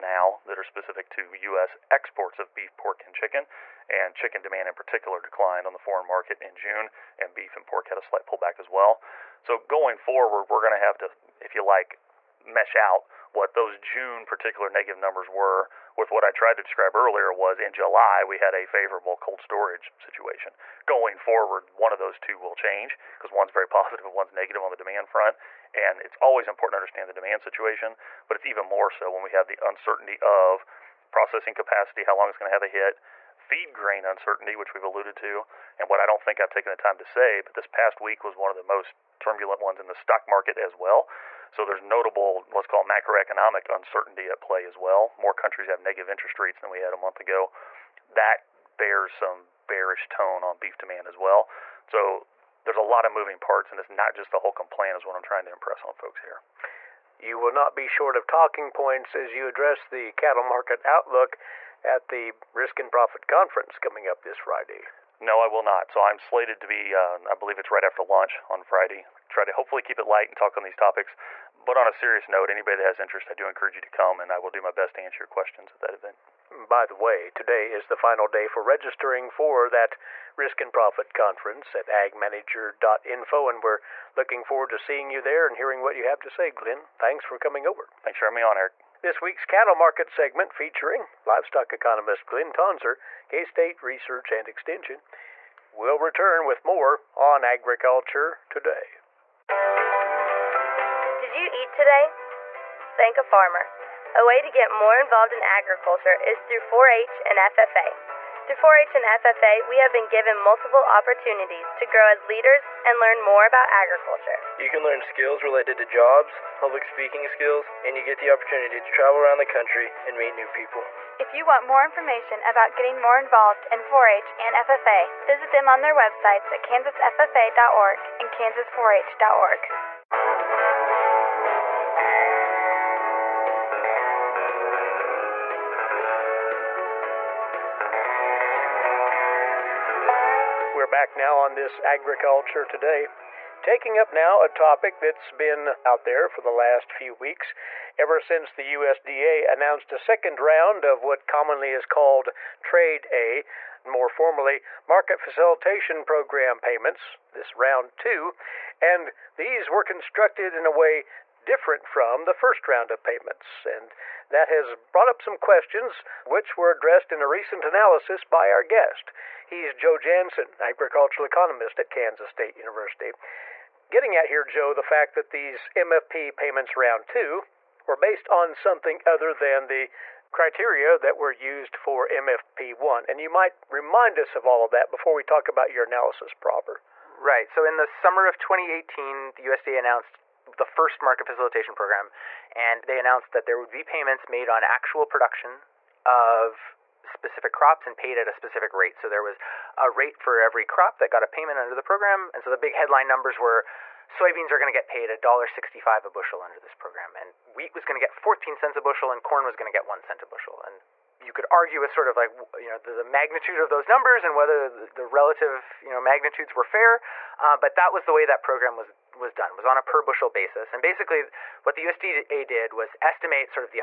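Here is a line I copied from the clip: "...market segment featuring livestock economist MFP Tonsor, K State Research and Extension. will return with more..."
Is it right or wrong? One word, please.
wrong.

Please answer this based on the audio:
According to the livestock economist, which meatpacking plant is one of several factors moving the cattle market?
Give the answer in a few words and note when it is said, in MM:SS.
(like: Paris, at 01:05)
Holcomb plant, at 00:54.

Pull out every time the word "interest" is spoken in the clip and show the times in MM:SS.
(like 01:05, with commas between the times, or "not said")
00:46, 01:12.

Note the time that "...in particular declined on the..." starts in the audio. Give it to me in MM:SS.
00:04.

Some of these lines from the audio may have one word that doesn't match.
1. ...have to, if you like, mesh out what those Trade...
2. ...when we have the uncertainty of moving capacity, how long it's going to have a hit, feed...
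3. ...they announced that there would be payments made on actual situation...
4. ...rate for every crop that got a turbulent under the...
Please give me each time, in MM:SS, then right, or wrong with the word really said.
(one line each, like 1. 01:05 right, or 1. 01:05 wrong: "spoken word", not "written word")
1. 00:10 wrong: "June", not "Trade"
2. 00:29 wrong: "processing", not "moving"
3. 03:12 wrong: "production", not "situation"
4. 03:19 wrong: "payment", not "turbulent".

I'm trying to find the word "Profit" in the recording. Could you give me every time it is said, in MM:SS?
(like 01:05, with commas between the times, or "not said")
01:02, 01:20.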